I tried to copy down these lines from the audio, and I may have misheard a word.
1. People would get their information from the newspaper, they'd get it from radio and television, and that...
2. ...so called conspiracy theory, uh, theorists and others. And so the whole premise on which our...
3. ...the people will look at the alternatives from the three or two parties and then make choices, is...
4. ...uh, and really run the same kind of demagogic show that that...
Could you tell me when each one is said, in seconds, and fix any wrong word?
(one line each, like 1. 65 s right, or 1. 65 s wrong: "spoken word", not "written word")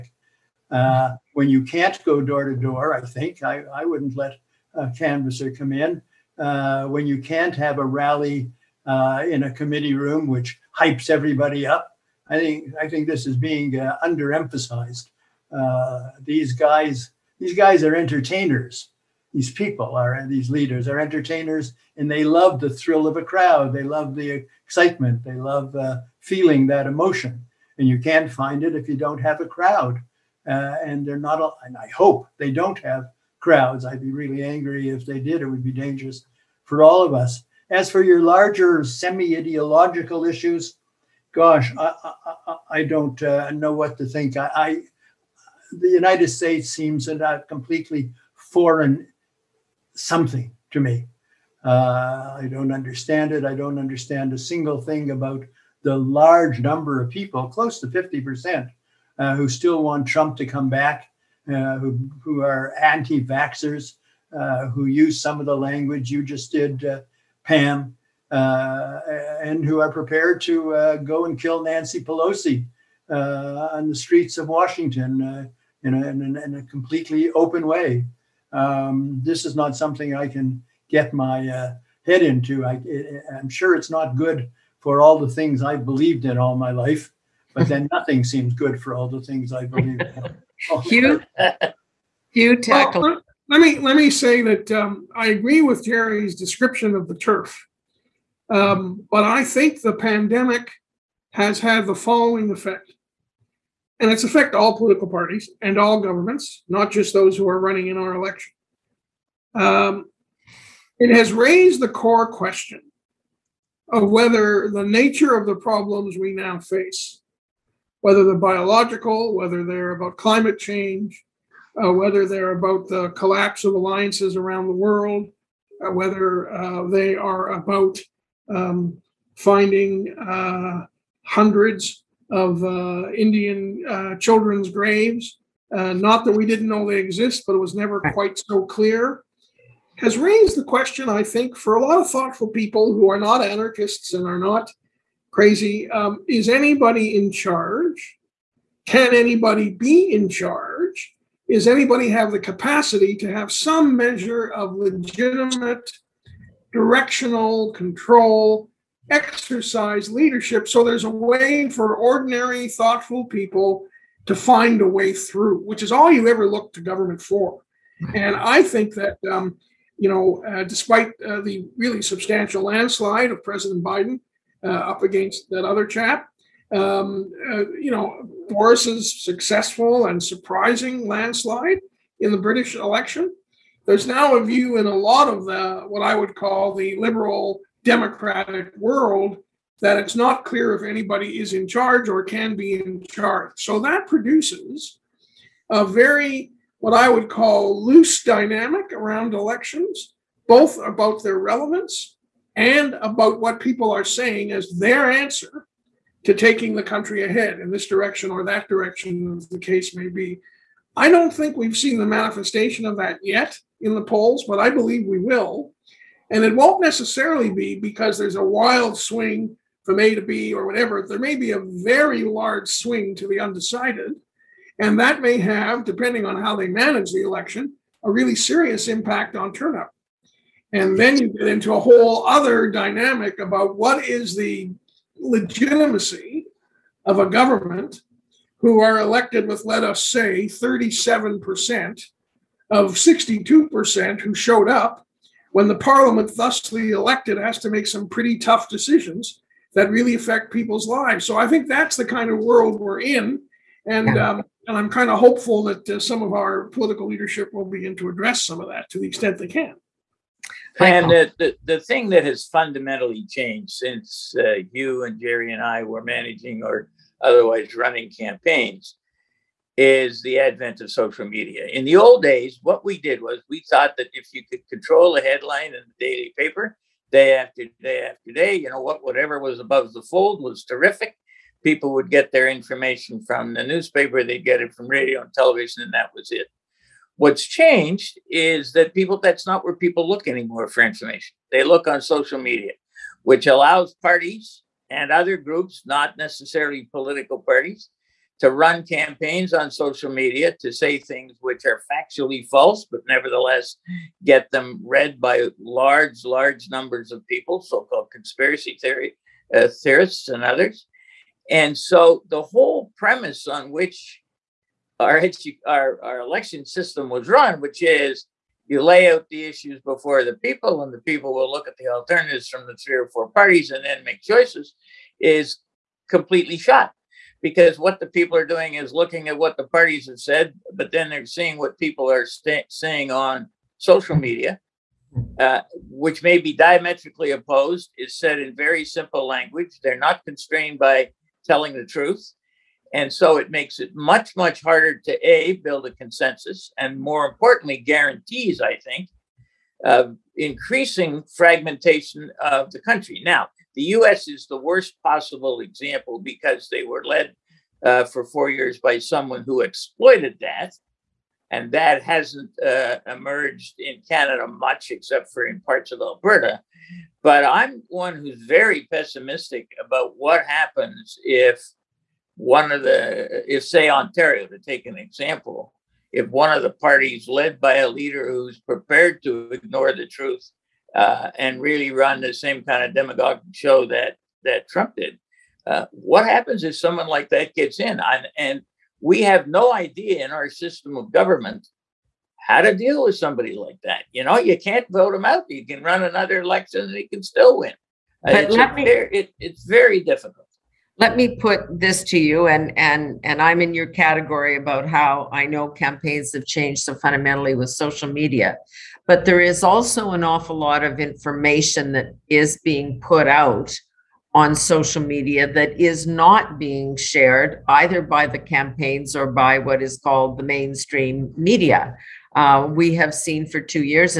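1. 281 s right
2. 307 s right
3. 320 s wrong: "four", not "two"
4. 380 s right.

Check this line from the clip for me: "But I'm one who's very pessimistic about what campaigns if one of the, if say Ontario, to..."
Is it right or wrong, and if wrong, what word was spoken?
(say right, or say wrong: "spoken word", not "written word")
wrong: "happens", not "campaigns".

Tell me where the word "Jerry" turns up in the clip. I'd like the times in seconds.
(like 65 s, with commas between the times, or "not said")
95 s, 265 s.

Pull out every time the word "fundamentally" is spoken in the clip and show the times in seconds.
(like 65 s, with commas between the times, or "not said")
262 s, 406 s.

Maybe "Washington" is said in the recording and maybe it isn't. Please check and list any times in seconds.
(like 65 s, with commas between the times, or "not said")
74 s.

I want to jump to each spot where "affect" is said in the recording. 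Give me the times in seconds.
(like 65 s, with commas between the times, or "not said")
104 s, 250 s.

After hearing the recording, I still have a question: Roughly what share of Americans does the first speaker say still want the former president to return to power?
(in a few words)
close to 50%.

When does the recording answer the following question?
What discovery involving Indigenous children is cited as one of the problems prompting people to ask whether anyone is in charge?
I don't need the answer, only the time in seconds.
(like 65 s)
134 s.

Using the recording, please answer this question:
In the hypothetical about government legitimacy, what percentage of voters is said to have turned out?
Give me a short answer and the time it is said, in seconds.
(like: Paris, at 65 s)
62%, at 242 s.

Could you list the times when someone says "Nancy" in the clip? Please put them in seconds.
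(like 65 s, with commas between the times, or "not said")
71 s.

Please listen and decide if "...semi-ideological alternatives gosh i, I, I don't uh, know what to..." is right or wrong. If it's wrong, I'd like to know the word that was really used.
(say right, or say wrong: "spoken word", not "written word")
wrong: "issues", not "alternatives".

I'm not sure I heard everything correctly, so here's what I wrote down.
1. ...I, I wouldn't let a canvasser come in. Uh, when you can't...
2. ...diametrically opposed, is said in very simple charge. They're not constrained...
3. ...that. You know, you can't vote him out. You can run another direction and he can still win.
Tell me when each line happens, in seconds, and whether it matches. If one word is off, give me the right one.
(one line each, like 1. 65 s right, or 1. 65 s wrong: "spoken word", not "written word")
1. 3 s right
2. 336 s wrong: "language", not "charge"
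3. 393 s wrong: "election", not "direction".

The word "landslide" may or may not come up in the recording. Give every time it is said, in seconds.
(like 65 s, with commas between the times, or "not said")
172 s, 181 s.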